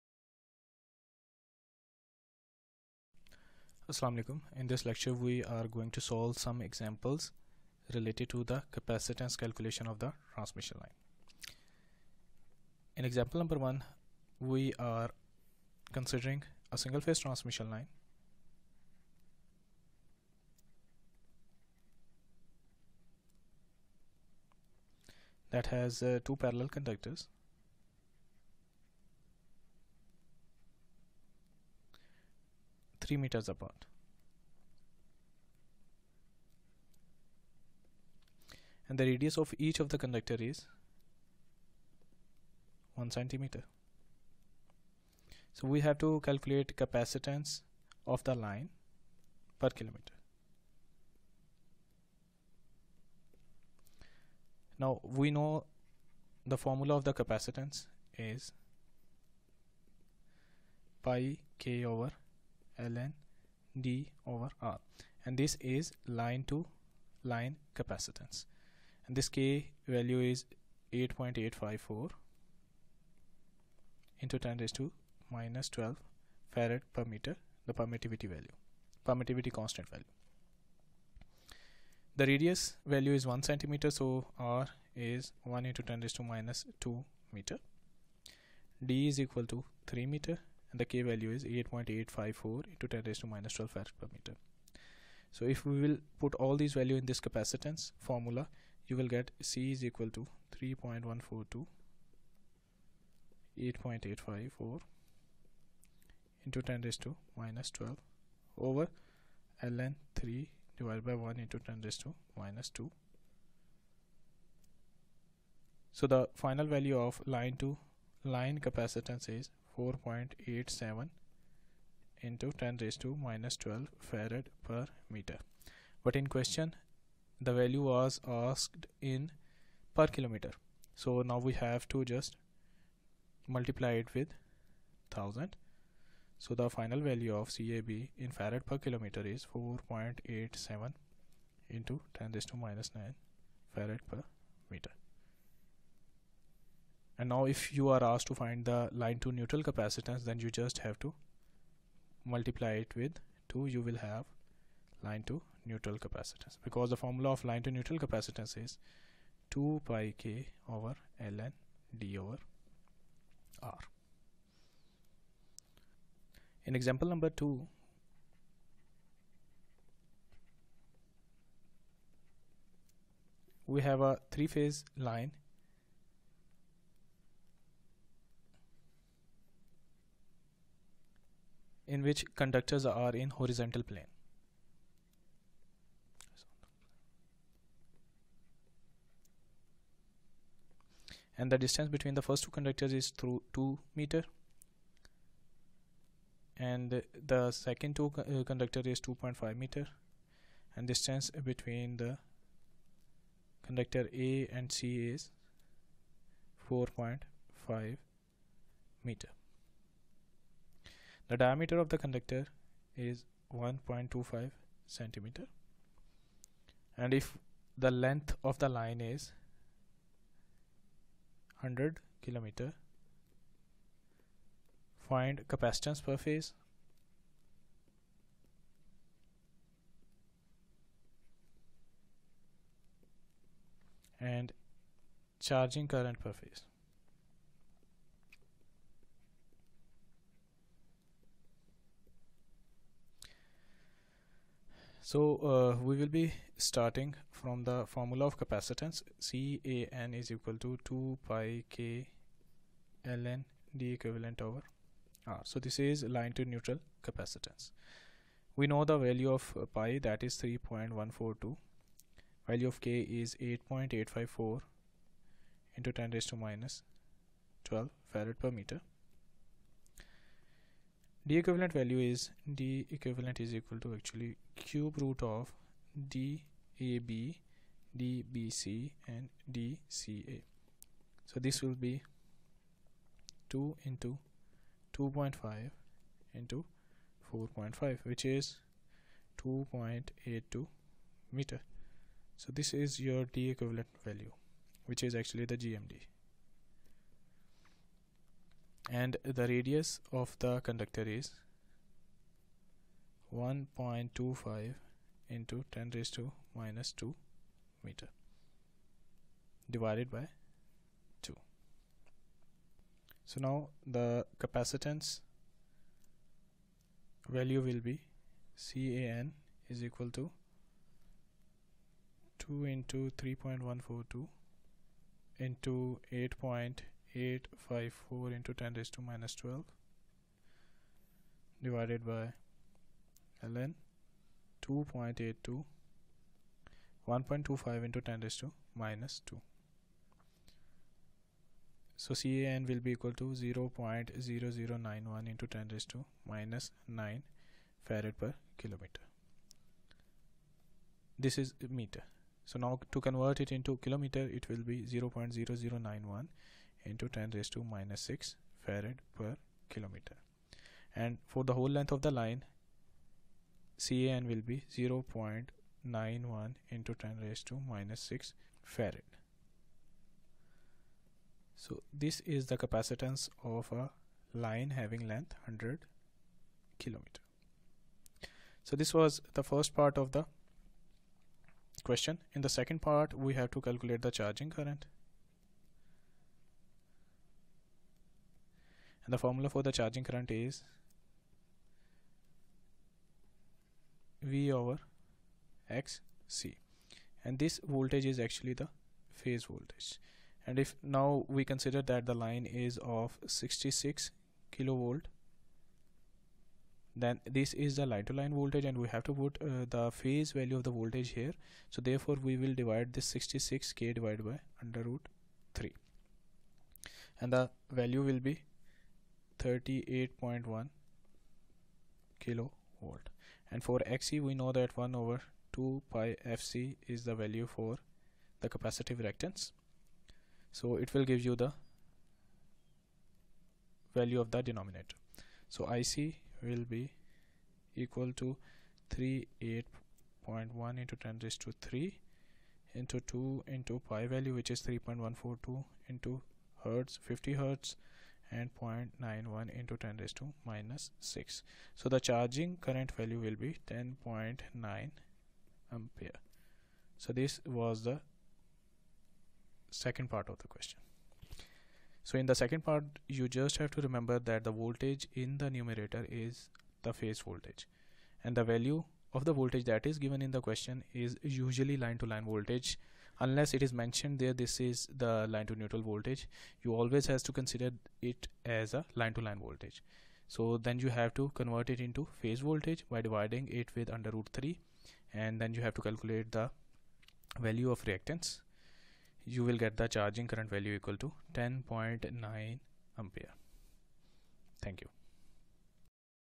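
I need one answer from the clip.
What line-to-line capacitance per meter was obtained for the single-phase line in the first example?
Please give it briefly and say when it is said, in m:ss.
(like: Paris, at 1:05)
4.87 × 10^-12 F/m, at 1:59.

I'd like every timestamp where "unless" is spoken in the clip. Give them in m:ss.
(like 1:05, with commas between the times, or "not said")
7:53.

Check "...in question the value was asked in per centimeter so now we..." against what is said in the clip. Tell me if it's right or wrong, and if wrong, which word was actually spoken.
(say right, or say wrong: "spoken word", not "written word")
wrong: "kilometer", not "centimeter".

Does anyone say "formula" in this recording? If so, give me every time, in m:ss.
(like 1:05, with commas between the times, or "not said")
0:56, 1:38, 2:37, 4:07, 6:29.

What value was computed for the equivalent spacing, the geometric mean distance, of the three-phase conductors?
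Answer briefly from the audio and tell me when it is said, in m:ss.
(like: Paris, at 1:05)
2.82 meters, at 4:49.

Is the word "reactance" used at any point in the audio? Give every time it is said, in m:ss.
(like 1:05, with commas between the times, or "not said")
7:09, 8:07.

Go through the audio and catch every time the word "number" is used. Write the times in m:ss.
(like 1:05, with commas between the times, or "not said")
0:13, 2:47.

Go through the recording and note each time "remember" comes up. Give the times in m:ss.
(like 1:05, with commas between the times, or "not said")
7:43.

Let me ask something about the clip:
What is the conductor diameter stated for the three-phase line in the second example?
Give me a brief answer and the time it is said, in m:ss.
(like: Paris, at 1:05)
1.25 centimeters, at 3:33.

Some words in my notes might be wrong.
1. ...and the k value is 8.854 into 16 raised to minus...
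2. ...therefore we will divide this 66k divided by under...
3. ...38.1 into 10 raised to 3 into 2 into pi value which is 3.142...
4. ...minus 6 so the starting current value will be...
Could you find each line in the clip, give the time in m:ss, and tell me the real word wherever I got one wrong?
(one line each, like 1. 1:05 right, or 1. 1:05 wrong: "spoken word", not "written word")
1. 1:30 wrong: "10", not "16"
2. 6:51 right
3. 7:18 right
4. 7:30 wrong: "charging", not "starting".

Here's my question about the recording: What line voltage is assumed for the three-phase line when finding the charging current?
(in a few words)
66 kV.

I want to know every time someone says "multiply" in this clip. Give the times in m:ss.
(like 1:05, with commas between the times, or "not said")
2:13, 2:32.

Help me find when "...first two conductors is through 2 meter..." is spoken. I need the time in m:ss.
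3:12.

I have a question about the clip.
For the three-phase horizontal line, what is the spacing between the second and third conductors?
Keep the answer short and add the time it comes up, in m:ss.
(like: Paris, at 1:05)
2.5 meters, at 3:19.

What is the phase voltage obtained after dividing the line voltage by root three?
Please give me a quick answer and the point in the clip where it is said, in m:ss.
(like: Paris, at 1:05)
38.1 kV, at 6:59.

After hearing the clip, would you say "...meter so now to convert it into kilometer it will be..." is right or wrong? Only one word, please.
right.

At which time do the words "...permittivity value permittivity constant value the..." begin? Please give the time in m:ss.
1:17.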